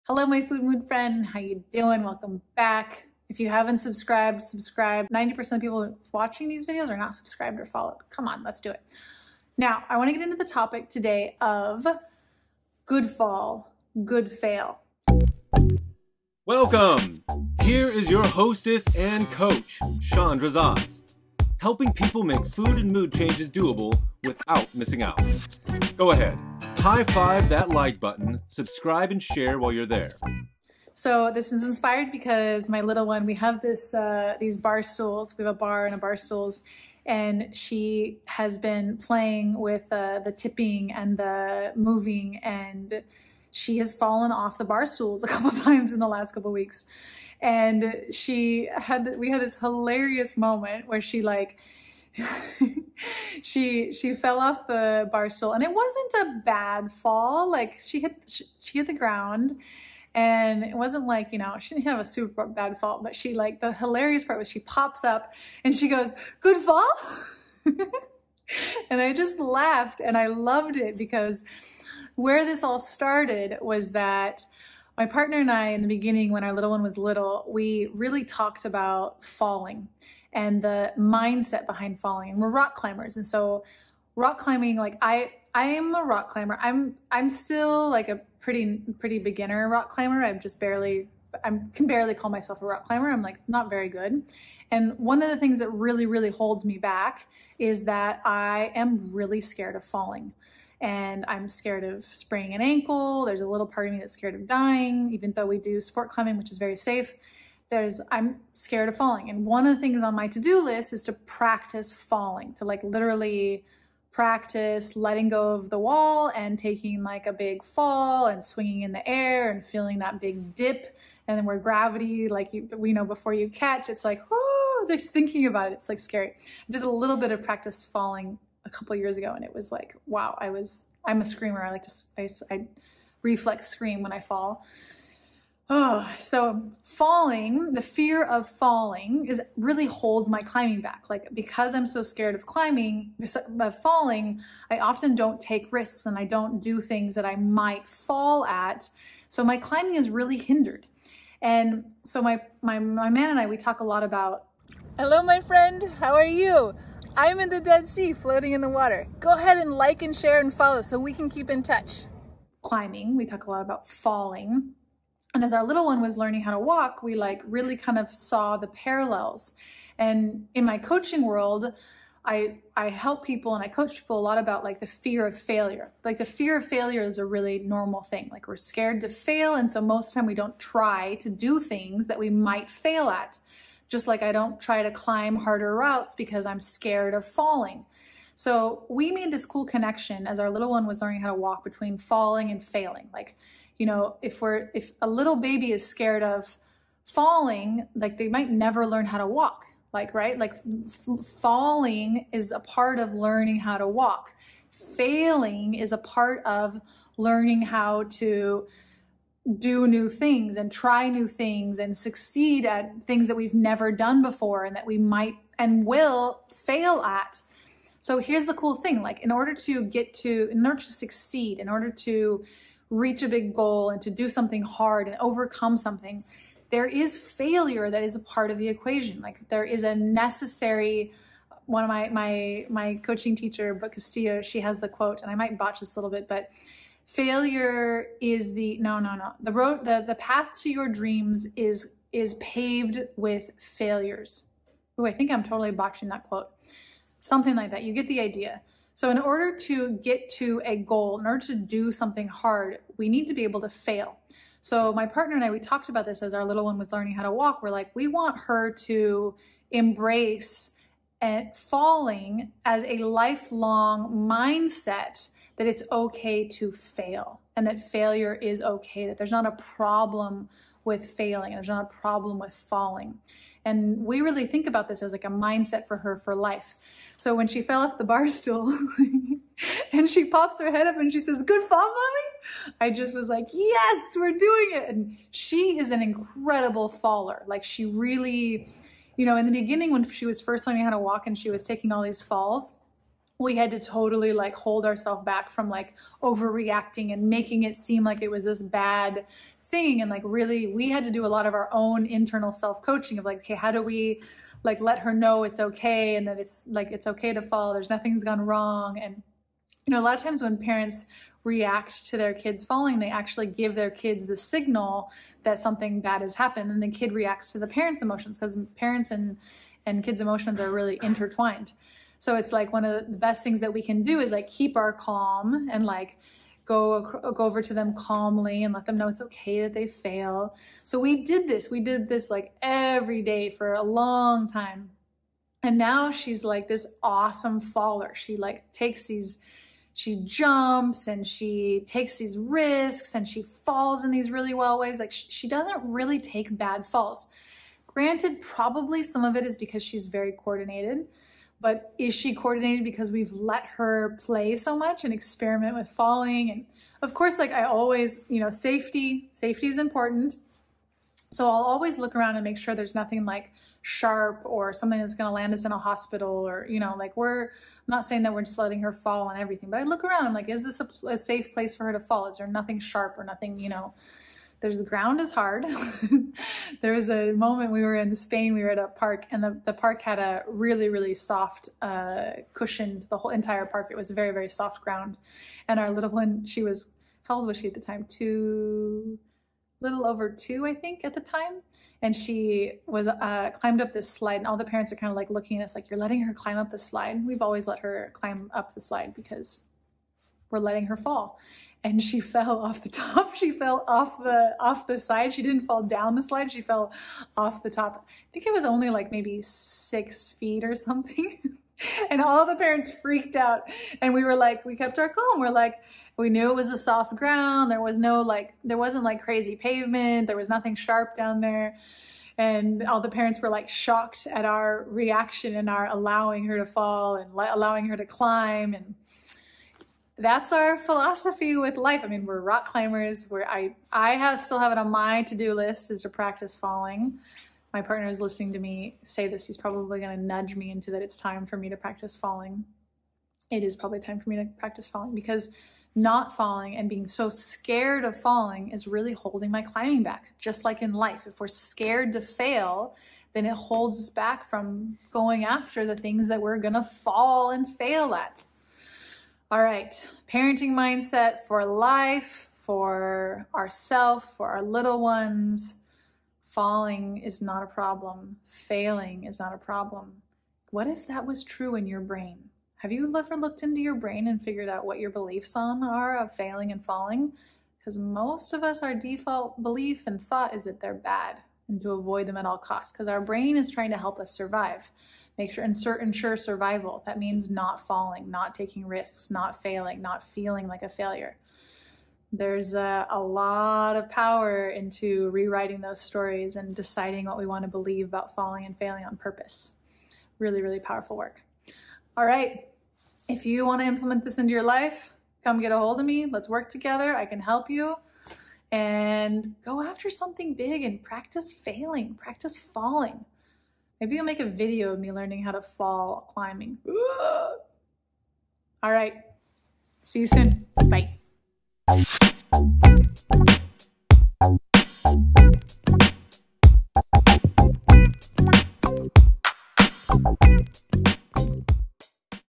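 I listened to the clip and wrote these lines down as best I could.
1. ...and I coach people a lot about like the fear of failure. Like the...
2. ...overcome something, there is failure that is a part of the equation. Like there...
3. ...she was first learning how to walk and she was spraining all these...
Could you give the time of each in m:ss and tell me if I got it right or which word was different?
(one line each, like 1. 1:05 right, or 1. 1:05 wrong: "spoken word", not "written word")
1. 2:53 right
2. 3:45 right
3. 4:50 wrong: "taking", not "spraining".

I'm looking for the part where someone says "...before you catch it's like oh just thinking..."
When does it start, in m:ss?
2:03.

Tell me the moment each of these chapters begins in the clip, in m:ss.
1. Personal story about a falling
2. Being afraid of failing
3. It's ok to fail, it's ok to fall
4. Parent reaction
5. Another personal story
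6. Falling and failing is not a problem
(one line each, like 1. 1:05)
1. 0:30
2. 3:00
3. 4:20
4. 5:10
5. 6:10
6. 7:40.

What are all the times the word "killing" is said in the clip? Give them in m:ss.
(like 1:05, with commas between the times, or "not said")
not said.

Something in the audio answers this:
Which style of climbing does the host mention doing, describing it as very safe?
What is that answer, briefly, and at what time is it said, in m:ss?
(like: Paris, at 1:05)
sport climbing, at 1:45.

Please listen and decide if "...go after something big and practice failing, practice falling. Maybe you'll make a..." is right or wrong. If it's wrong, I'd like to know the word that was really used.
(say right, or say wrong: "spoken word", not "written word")
right.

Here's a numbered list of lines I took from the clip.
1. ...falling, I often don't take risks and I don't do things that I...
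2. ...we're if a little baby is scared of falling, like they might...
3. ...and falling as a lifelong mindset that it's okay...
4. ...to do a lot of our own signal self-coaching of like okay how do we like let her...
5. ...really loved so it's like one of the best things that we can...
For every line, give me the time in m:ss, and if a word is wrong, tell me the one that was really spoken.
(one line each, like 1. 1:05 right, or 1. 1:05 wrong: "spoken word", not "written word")
1. 2:23 right
2. 3:14 right
3. 4:21 right
4. 5:01 wrong: "internal", not "signal"
5. 5:20 wrong: "intertwined", not "loved".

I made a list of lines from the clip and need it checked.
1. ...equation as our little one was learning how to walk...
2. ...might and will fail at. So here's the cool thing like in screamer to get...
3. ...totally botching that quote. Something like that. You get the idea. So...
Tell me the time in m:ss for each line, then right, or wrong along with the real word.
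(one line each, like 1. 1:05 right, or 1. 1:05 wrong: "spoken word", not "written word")
1. 3:09 wrong: "connection", not "equation"
2. 3:34 wrong: "order", not "screamer"
3. 4:05 right.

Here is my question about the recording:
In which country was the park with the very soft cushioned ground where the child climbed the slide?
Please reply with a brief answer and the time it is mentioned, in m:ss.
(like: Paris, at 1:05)
Spain, at 6:18.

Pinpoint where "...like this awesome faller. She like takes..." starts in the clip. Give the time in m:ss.
5:36.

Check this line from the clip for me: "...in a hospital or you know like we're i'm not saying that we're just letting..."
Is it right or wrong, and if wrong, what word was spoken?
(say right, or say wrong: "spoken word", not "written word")
right.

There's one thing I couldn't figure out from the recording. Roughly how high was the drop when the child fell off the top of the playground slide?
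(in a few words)
6 feet.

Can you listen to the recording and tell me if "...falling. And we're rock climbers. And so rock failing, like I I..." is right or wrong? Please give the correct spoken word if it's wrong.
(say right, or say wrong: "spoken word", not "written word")
wrong: "climbing", not "failing".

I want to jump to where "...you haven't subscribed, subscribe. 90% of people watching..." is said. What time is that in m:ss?
0:03.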